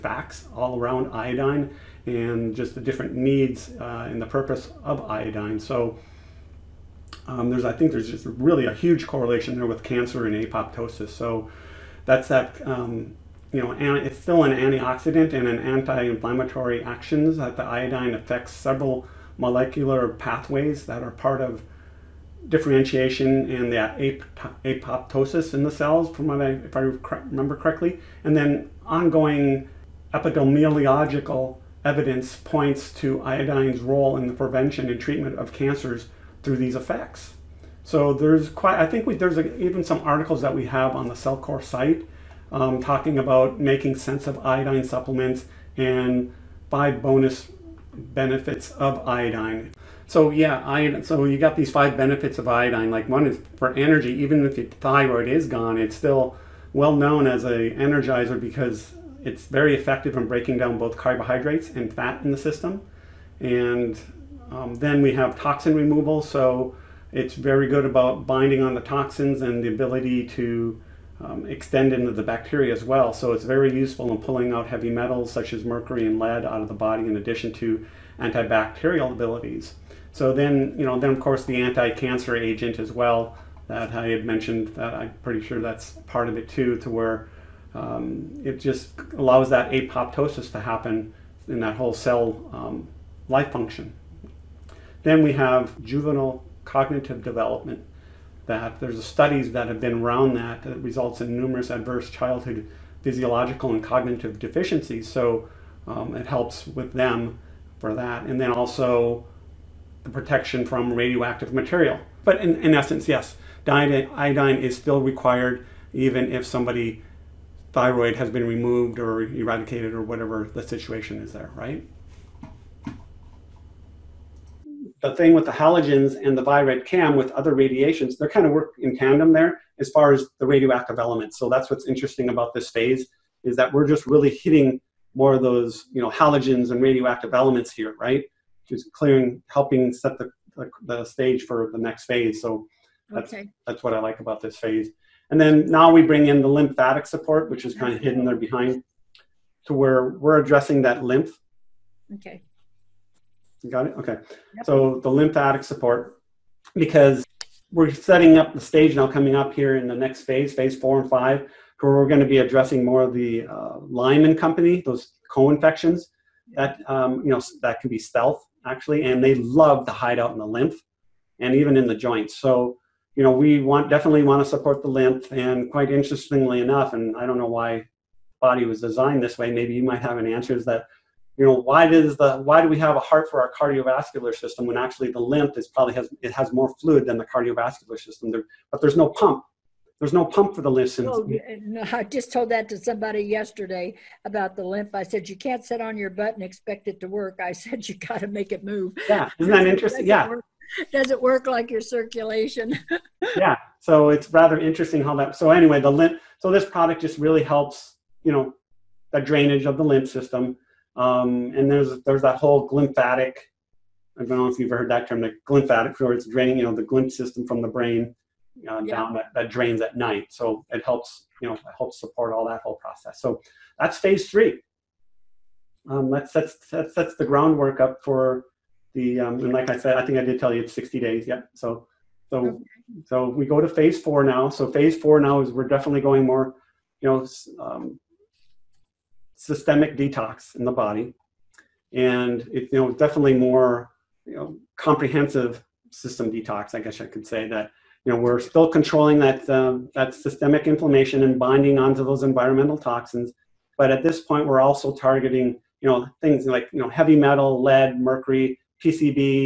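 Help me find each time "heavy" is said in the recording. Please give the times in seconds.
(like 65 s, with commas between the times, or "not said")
74 s, 256 s.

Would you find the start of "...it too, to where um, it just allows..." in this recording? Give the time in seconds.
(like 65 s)
86 s.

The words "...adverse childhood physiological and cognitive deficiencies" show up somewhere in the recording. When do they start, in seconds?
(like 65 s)
101 s.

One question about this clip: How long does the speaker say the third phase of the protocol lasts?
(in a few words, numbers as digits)
60 days.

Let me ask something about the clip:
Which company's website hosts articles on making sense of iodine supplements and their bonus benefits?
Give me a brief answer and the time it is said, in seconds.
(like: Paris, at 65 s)
Cellcore, at 41 s.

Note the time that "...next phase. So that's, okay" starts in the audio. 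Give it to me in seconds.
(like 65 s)
141 s.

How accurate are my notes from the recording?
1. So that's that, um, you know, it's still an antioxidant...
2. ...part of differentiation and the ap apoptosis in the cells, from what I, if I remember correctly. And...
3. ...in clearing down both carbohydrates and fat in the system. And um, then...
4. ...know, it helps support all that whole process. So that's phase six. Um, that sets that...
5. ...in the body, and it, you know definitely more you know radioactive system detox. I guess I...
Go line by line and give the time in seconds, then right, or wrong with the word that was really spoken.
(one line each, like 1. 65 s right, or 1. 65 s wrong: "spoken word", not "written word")
1. 11 s right
2. 21 s right
3. 60 s wrong: "breaking", not "clearing"
4. 221 s wrong: "three", not "six"
5. 240 s wrong: "comprehensive", not "radioactive".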